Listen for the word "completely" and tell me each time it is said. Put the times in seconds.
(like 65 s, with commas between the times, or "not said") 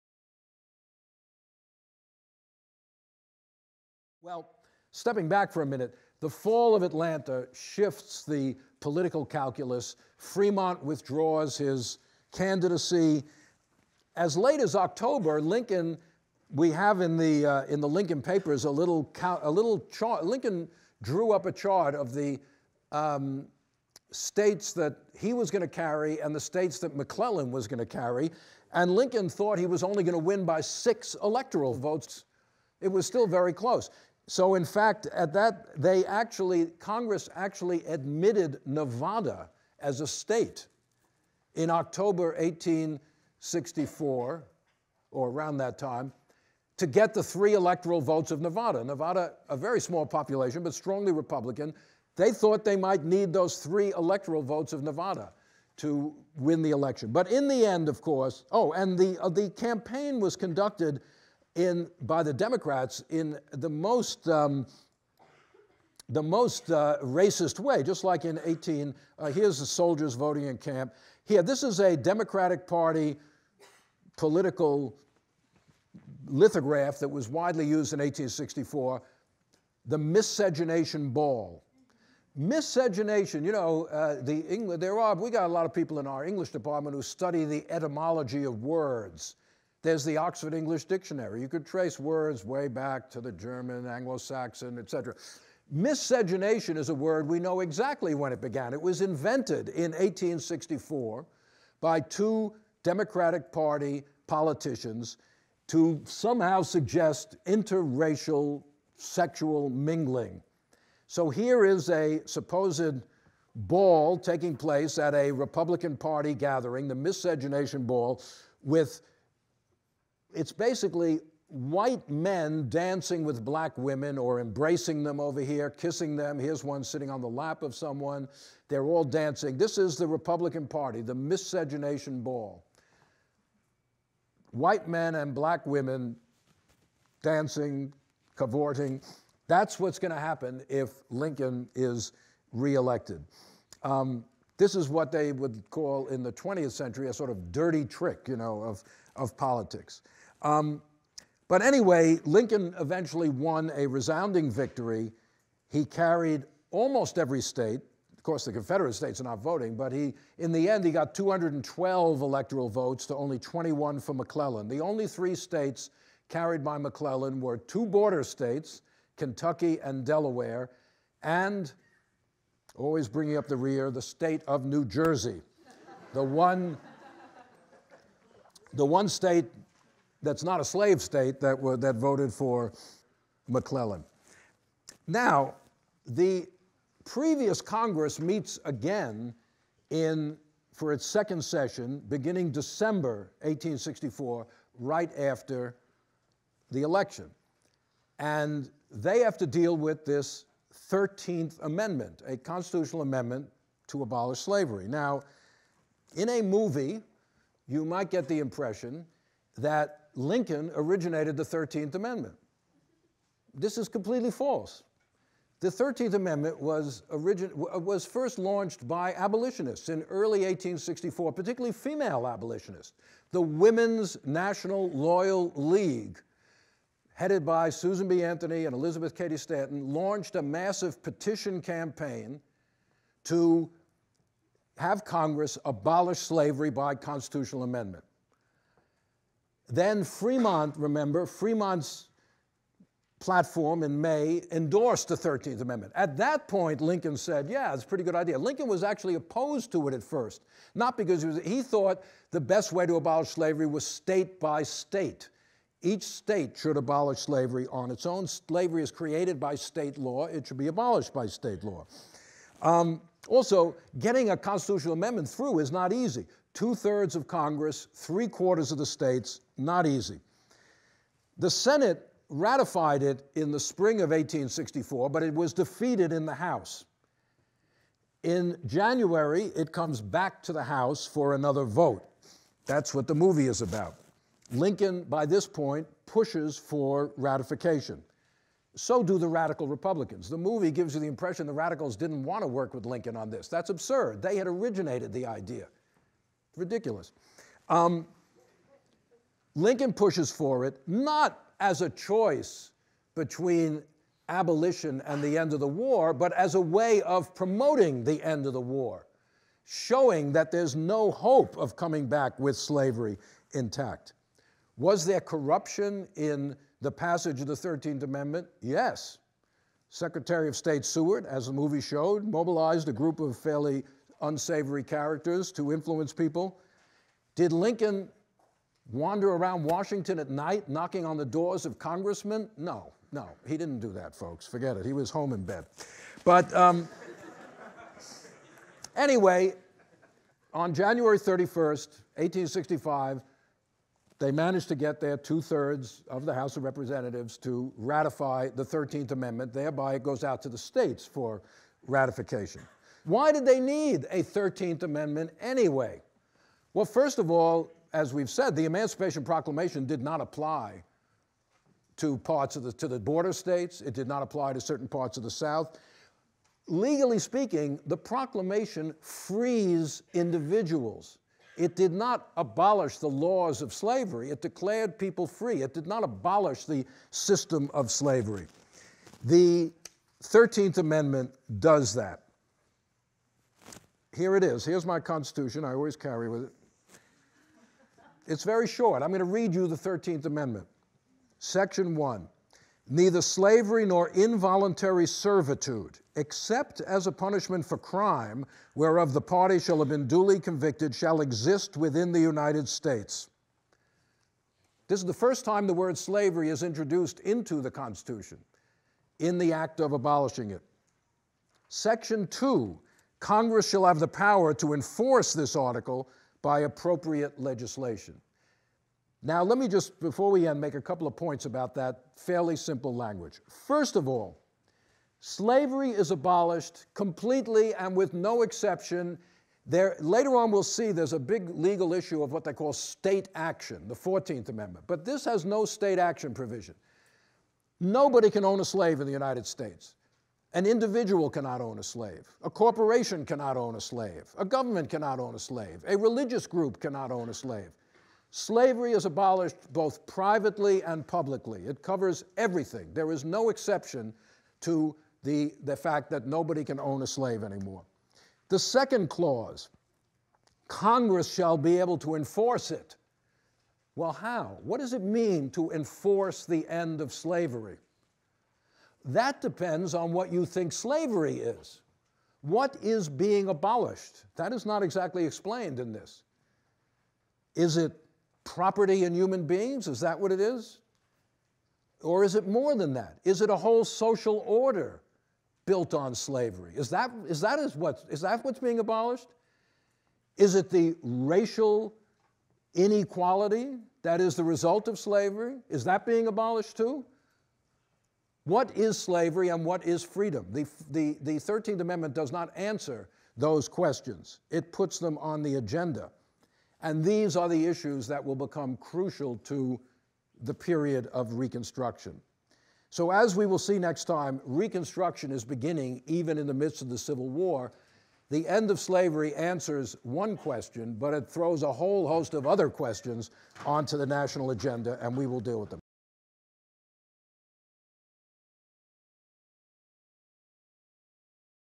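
213 s, 426 s.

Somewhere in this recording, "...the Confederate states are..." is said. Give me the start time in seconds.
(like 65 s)
158 s.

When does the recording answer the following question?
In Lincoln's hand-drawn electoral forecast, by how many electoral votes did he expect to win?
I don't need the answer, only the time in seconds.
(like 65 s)
30 s.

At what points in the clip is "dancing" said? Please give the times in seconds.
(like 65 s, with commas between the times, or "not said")
122 s, 129 s, 137 s.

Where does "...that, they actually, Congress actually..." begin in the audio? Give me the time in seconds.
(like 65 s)
35 s.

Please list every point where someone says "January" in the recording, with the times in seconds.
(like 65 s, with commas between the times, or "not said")
278 s, 340 s.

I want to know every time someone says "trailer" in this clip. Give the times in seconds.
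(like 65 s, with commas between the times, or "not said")
not said.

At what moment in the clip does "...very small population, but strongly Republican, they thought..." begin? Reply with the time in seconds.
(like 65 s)
49 s.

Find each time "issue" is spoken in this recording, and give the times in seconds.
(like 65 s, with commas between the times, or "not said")
431 s, 507 s.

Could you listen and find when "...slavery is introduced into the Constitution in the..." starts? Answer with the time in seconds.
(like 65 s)
405 s.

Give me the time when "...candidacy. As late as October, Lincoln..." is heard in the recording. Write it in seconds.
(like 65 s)
12 s.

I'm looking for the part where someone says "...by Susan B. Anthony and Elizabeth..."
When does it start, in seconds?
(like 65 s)
227 s.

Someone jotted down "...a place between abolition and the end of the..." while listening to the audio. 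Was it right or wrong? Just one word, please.
wrong.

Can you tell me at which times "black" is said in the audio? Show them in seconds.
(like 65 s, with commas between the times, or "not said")
123 s, 135 s.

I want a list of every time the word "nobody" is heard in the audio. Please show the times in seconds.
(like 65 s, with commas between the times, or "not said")
437 s, 456 s.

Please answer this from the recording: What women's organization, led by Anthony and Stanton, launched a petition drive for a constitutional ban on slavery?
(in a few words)
Women's National Loyal League.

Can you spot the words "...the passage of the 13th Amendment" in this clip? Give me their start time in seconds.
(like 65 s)
316 s.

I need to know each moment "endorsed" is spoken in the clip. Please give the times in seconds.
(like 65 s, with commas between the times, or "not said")
244 s.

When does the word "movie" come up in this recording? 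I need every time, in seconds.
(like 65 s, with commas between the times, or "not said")
206 s, 283 s, 290 s, 321 s.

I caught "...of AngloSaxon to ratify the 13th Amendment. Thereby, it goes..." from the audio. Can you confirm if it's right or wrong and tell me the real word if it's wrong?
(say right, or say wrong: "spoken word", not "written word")
wrong: "Representatives", not "AngloSaxon".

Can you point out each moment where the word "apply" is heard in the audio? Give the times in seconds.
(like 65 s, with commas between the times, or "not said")
360 s, 364 s.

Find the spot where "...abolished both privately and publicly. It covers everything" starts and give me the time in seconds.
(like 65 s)
449 s.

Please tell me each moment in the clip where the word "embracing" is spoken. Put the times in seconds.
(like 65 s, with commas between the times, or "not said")
124 s.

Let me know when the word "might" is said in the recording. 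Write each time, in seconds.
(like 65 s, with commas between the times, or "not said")
52 s, 207 s.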